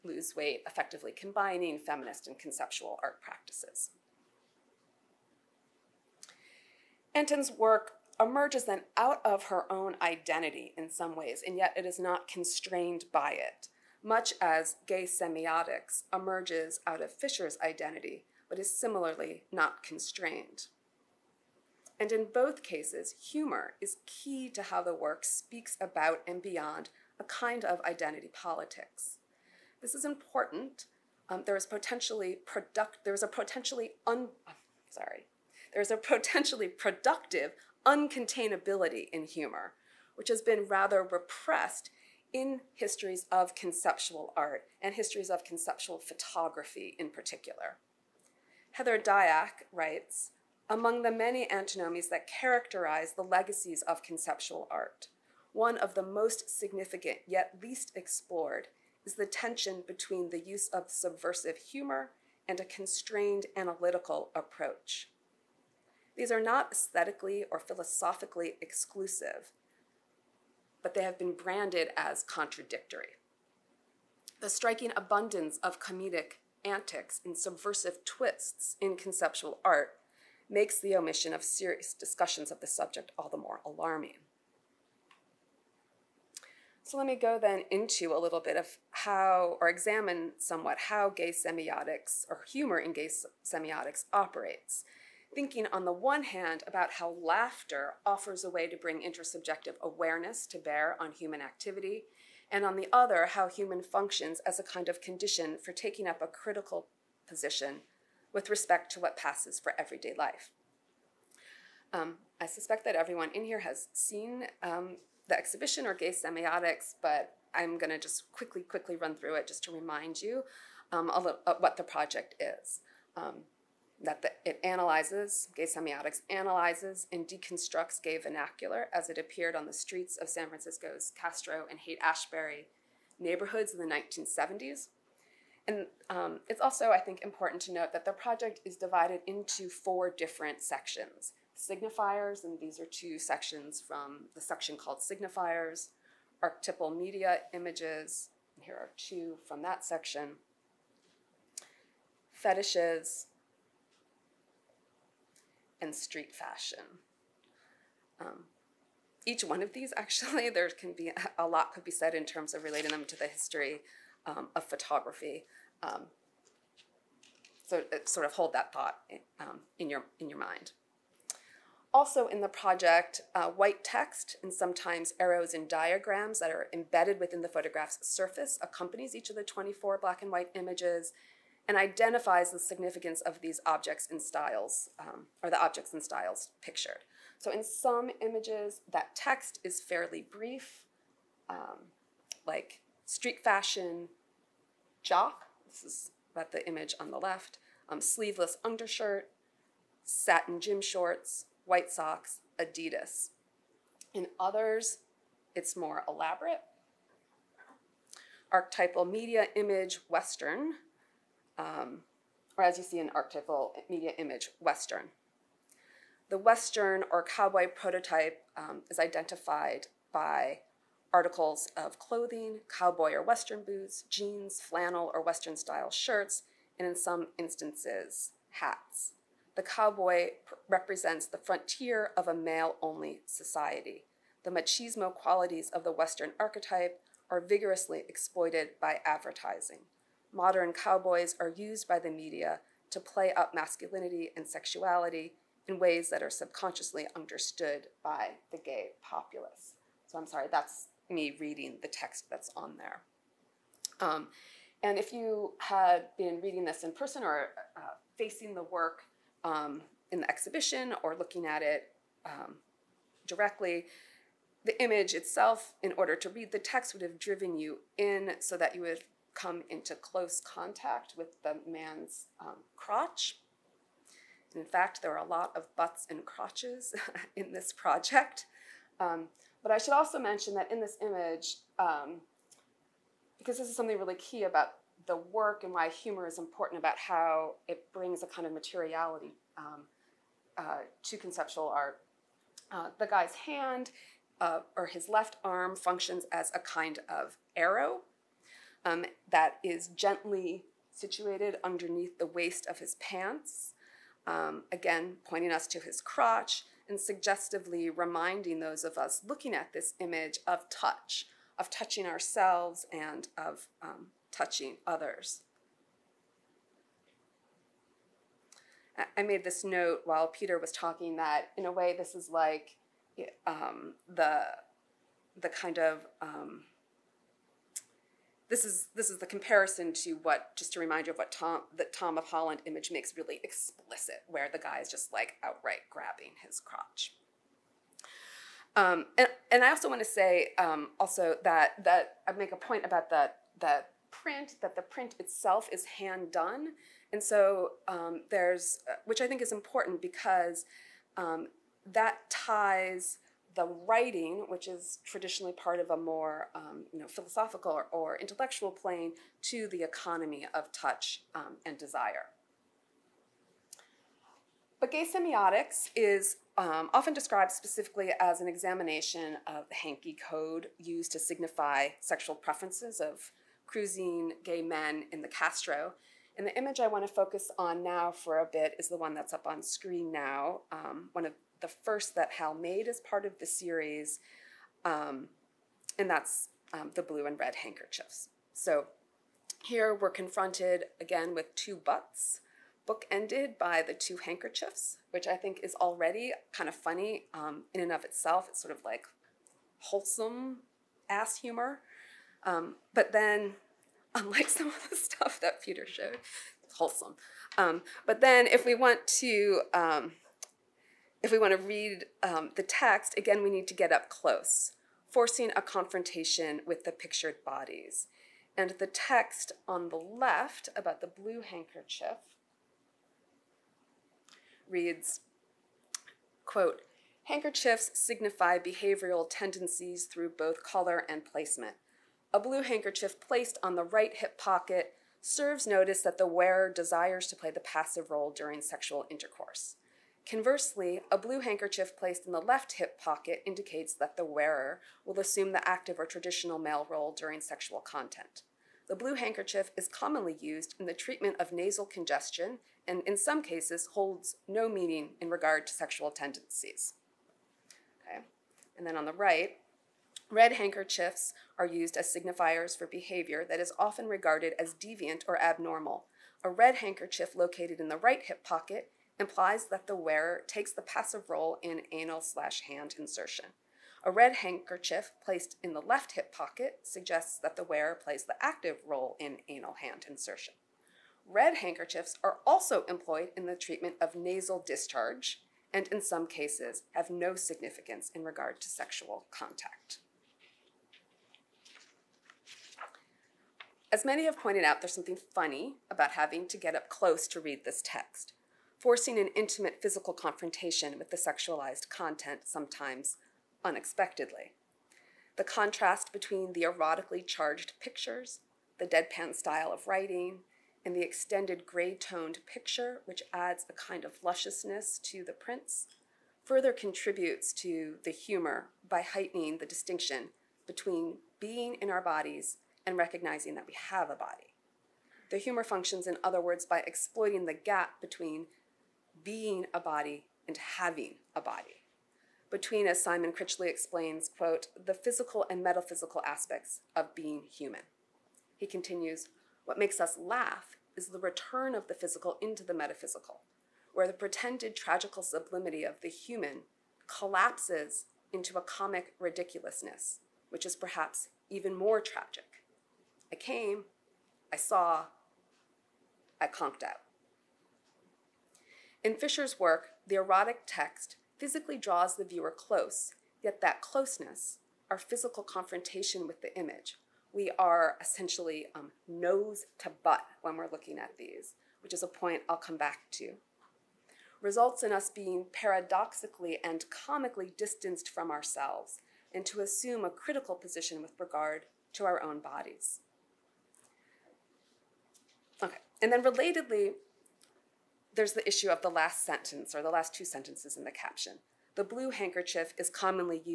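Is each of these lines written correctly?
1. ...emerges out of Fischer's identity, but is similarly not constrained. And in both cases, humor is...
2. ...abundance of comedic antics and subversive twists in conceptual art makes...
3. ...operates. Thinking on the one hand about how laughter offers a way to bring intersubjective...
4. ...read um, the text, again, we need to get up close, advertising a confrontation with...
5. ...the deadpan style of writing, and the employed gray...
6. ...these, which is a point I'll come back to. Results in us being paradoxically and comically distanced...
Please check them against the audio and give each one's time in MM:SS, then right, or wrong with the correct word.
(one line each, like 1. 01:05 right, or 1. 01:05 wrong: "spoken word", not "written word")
1. 00:16 right
2. 01:14 right
3. 01:34 right
4. 06:51 wrong: "forcing", not "advertising"
5. 08:28 wrong: "extended", not "employed"
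6. 09:31 right.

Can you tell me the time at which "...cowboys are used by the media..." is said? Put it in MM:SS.
04:00.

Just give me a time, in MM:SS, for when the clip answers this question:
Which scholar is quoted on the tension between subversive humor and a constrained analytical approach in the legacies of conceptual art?
00:48.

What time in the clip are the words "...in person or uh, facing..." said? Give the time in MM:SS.
04:16.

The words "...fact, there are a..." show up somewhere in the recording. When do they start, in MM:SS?
04:34.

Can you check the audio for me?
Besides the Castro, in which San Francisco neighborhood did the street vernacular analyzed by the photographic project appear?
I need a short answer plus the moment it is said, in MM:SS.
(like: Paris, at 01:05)
Haight Ashbury, at 02:11.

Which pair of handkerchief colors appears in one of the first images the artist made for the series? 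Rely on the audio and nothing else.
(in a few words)
blue and red.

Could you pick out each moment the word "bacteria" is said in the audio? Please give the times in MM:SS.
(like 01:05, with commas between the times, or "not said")
not said.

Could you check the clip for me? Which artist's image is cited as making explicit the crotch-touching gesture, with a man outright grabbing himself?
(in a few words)
Tom of Holland.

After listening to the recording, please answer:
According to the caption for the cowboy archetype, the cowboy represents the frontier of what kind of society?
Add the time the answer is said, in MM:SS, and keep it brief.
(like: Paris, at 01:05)
male only society, at 03:52.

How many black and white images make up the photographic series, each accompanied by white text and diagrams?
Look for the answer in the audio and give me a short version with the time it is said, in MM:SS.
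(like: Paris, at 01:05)
24, at 02:59.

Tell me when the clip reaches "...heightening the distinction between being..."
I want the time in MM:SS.
08:39.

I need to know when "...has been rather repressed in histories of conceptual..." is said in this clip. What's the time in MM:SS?
00:40.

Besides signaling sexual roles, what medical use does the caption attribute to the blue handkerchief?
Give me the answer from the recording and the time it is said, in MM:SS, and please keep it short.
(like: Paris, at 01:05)
nasal congestion, at 07:31.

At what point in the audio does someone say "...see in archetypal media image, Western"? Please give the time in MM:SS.
03:32.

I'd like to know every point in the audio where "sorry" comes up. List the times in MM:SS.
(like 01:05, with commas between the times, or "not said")
00:34, 04:10.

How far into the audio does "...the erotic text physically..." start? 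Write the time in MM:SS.
09:20.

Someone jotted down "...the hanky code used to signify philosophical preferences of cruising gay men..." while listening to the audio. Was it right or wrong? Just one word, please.
wrong.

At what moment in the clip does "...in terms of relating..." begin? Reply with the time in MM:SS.
02:42.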